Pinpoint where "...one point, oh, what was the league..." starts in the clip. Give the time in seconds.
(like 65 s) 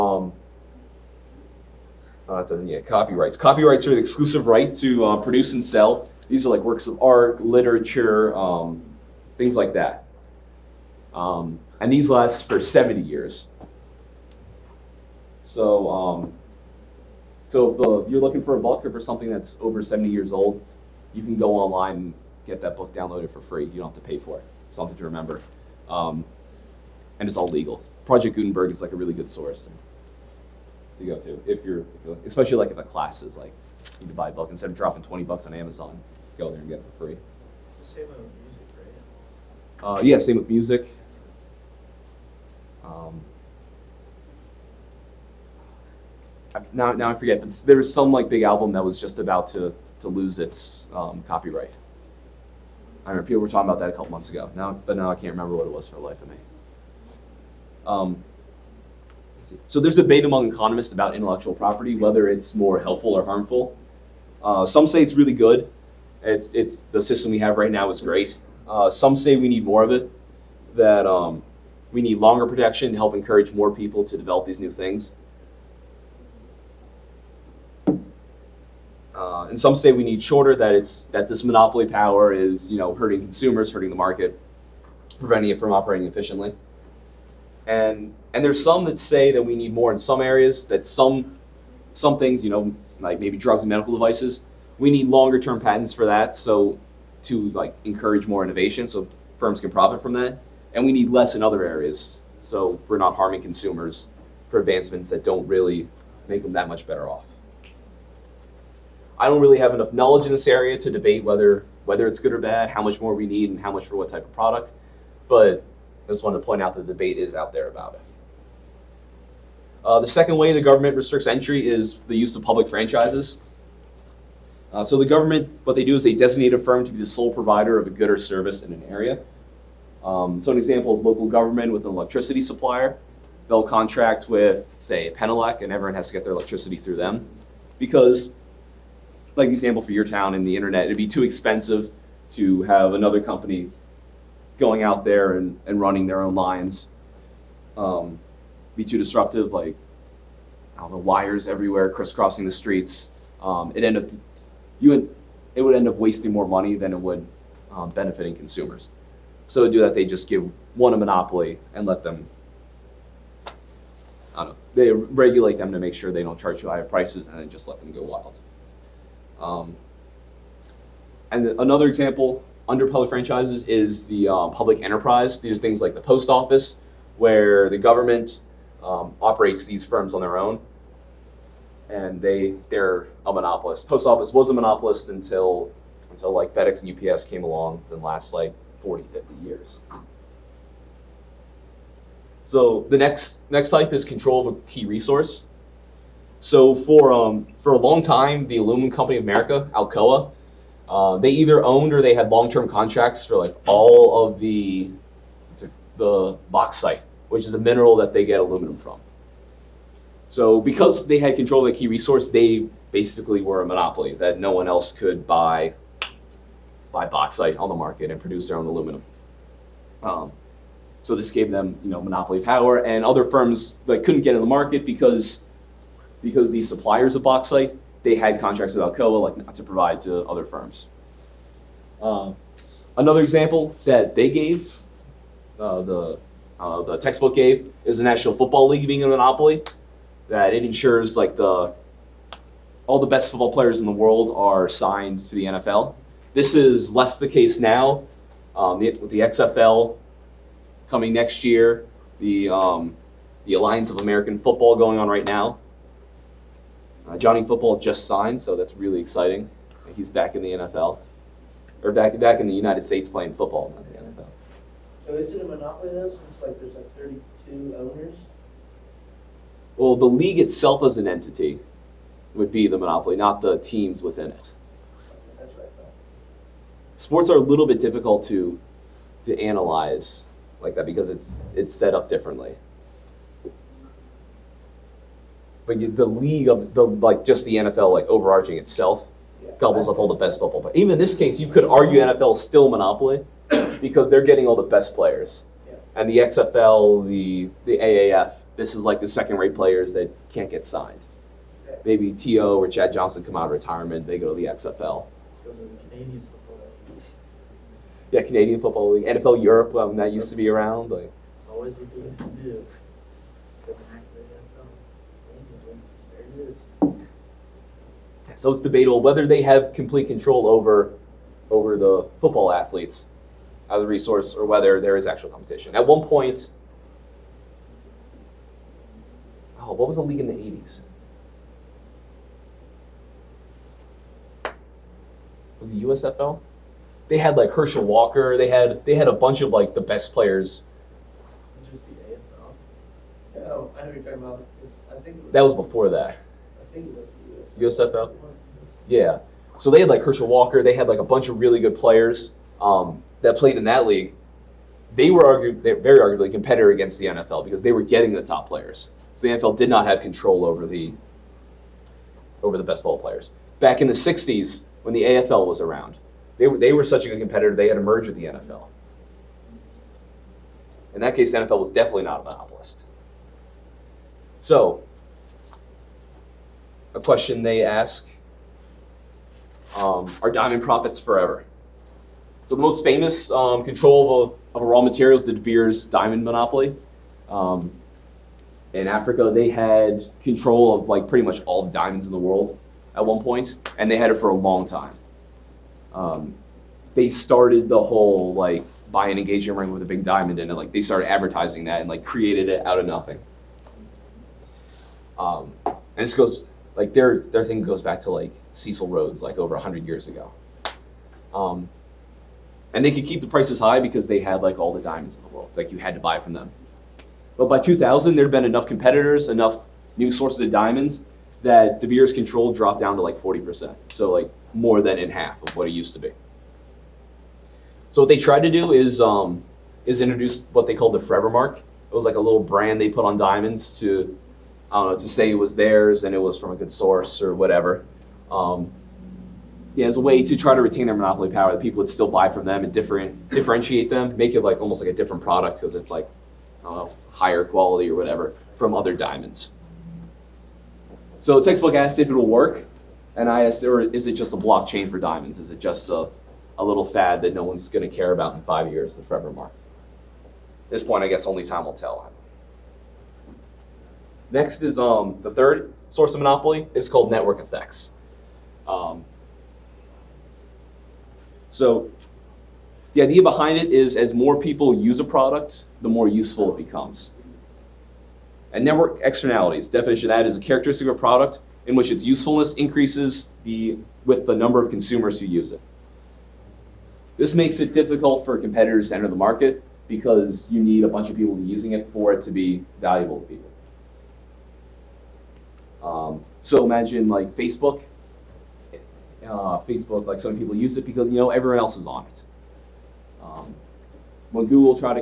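325 s.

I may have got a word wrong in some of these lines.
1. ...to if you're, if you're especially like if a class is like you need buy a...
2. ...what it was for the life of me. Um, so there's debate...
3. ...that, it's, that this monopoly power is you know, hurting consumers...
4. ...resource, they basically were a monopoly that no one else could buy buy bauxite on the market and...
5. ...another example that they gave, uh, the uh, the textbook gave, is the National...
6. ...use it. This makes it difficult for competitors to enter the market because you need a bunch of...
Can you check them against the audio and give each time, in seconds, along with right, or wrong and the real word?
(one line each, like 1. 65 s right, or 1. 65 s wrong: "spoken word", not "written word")
1. 31 s right
2. 55 s right
3. 80 s right
4. 211 s right
5. 232 s right
6. 485 s right.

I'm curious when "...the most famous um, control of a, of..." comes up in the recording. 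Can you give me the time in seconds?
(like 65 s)
382 s.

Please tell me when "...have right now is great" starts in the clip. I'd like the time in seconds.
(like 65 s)
67 s.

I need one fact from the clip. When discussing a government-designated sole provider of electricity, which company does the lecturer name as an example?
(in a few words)
Penelec.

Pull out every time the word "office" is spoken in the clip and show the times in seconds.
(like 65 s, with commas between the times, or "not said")
176 s, 184 s.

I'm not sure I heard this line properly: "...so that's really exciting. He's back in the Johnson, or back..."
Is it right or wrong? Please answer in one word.
wrong.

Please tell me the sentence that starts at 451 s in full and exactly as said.
So textbook asked if it'll work, and I asked, or is it just a blockchain for diamonds?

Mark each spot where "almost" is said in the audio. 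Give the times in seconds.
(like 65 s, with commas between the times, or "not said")
444 s.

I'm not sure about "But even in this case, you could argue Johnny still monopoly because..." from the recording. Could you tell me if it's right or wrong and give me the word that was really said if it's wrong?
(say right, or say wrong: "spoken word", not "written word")
wrong: "NFL", not "Johnny".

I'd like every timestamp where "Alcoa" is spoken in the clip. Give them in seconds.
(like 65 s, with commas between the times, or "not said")
199 s, 228 s.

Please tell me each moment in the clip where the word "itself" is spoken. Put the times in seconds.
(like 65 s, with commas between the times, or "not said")
270 s, 288 s.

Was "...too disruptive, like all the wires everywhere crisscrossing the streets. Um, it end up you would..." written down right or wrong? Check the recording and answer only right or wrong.
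right.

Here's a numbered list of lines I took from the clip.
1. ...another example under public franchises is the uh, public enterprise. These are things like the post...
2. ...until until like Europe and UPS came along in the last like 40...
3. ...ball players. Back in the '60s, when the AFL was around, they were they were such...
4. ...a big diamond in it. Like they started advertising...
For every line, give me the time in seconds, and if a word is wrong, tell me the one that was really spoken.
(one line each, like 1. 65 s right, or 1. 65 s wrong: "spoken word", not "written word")
1. 171 s right
2. 185 s wrong: "FedEx", not "Europe"
3. 362 s right
4. 399 s right.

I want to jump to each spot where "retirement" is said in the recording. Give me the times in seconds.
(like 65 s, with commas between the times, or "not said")
303 s.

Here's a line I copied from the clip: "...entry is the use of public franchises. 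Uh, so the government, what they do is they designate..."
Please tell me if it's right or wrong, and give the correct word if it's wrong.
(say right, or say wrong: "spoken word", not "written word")
right.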